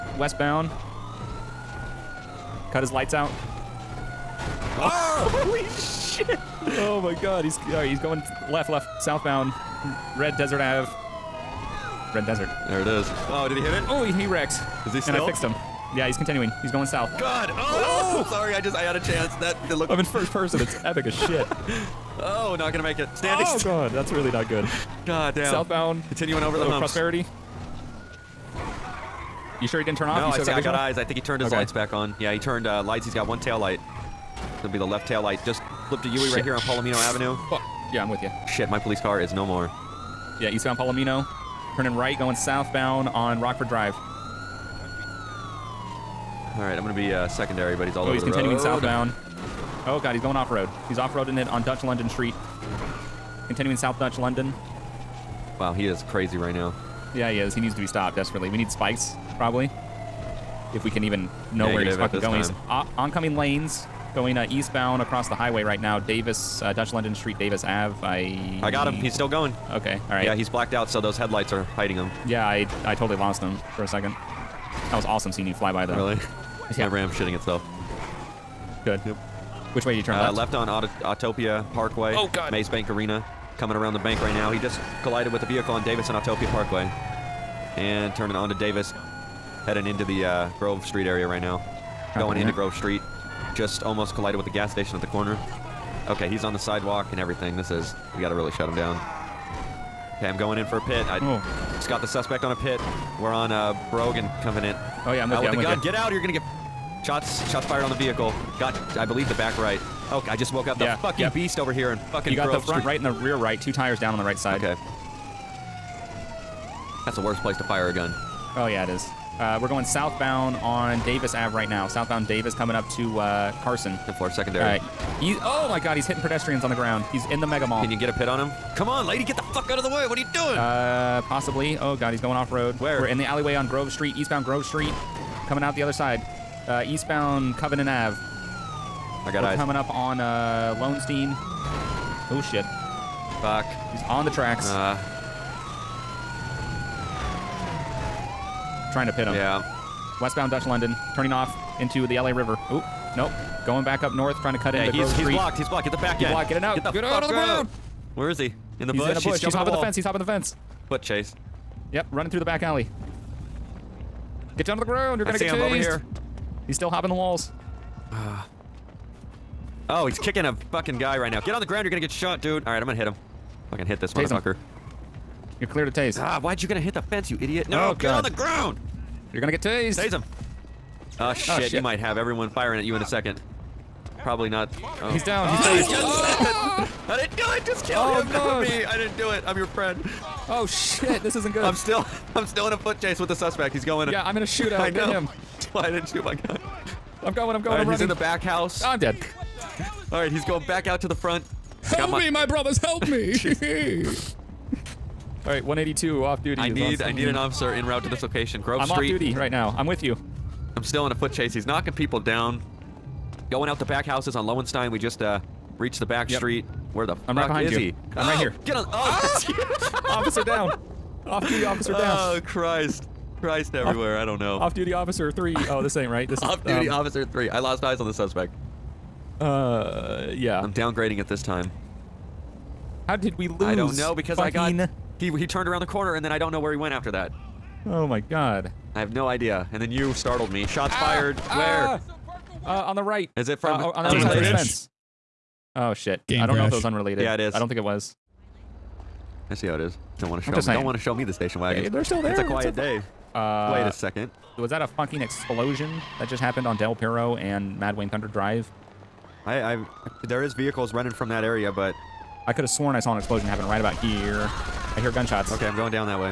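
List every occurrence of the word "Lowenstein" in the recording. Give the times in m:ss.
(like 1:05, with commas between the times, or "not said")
2:20, 3:34.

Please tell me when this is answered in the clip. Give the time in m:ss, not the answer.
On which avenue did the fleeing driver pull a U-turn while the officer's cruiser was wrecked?
0:36.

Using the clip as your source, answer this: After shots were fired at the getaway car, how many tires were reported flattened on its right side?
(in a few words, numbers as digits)
2.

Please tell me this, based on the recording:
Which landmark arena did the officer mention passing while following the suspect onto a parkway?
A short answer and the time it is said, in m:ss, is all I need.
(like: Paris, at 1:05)
Maze Bank Arena, at 1:22.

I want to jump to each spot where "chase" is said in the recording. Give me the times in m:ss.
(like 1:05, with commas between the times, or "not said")
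2:41, 3:12, 3:31.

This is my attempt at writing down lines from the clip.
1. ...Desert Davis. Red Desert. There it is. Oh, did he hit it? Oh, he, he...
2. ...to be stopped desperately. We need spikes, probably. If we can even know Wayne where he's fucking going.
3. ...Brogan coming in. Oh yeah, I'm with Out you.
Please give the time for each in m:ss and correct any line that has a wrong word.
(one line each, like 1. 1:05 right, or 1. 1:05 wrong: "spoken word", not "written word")
1. 0:10 wrong: "Ave", not "Davis"
2. 0:57 wrong: "Negative", not "Wayne"
3. 1:43 right.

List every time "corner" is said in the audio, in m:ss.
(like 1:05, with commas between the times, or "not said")
1:35, 3:55.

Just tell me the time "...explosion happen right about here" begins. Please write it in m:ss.
4:23.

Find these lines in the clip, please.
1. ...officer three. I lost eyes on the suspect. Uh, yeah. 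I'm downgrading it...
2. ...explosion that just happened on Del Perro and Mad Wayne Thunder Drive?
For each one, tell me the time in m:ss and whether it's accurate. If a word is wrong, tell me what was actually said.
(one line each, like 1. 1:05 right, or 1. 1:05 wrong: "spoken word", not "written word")
1. 3:47 right
2. 4:15 right.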